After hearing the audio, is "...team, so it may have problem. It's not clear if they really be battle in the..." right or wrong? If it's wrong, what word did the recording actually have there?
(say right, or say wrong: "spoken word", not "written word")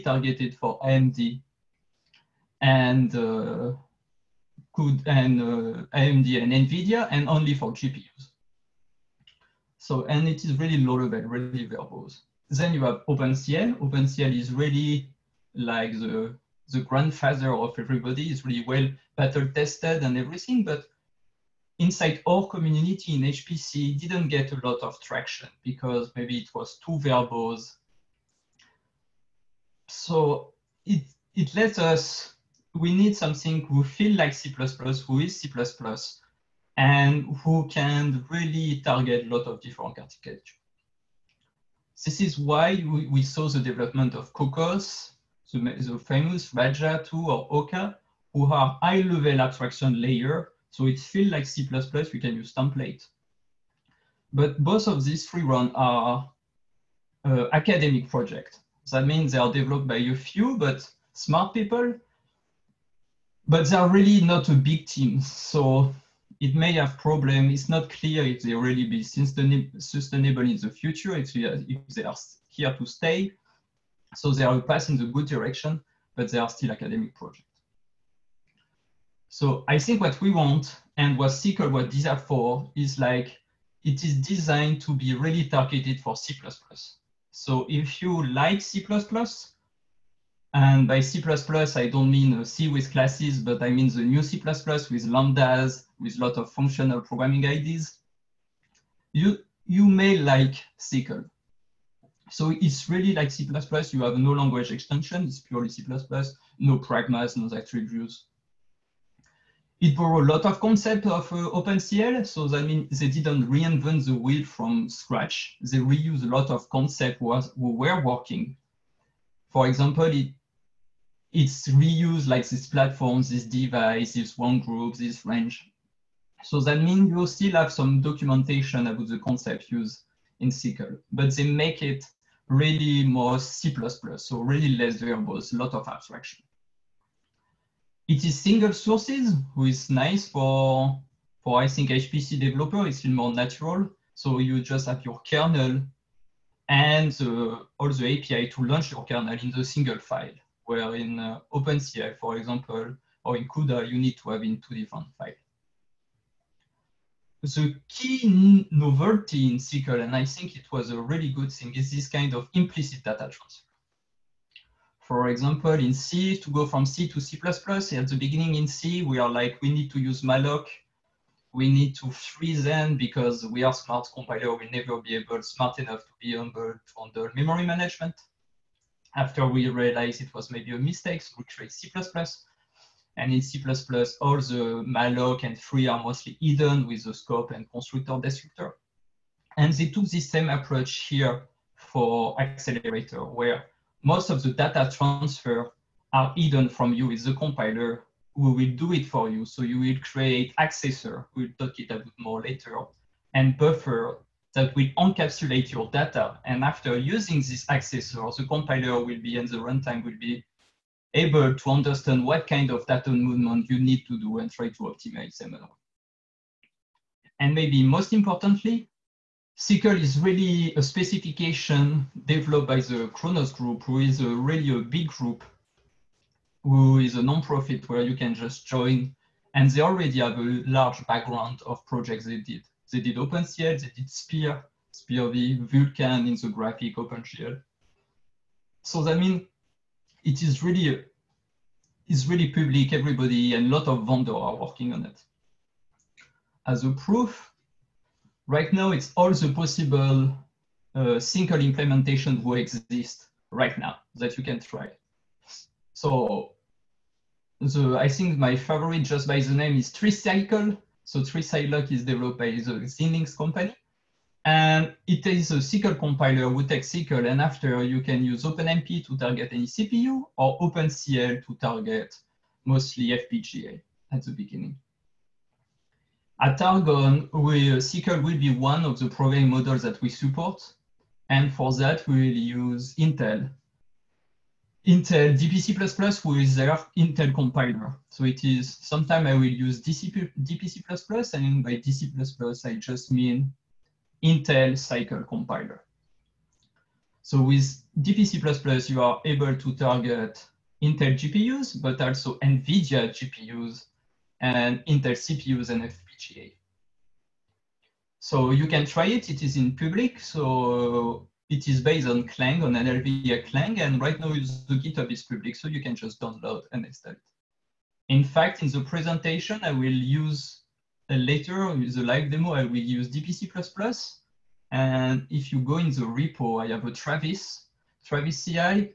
wrong: "sustainable", not "battle".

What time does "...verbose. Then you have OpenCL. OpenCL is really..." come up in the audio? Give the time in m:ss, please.
0:11.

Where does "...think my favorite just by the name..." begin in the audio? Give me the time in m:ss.
4:18.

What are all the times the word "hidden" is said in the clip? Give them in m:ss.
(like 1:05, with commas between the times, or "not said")
3:06, 3:16.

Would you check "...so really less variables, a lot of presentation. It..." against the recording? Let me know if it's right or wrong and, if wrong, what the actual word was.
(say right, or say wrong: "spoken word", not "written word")
wrong: "abstraction", not "presentation".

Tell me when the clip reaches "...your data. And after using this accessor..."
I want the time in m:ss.
3:25.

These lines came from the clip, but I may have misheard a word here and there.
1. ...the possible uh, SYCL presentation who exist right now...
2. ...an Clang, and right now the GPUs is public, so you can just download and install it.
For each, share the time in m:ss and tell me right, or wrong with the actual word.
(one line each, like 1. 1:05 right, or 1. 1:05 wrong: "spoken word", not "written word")
1. 4:09 wrong: "implementation", not "presentation"
2. 5:12 wrong: "GitHub", not "GPUs".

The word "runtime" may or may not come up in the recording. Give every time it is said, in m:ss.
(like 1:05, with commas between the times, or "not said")
3:29.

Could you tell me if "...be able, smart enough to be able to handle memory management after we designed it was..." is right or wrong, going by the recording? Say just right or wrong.
wrong.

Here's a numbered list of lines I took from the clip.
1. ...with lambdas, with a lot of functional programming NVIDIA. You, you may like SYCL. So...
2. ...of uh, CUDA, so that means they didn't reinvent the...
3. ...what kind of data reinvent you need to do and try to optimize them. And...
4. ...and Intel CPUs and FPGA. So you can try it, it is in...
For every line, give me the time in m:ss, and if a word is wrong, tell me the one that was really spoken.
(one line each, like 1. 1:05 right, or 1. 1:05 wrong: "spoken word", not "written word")
1. 1:34 wrong: "IDs", not "NVIDIA"
2. 1:51 wrong: "OpenCL", not "CUDA"
3. 3:32 wrong: "movement", not "reinvent"
4. 5:04 right.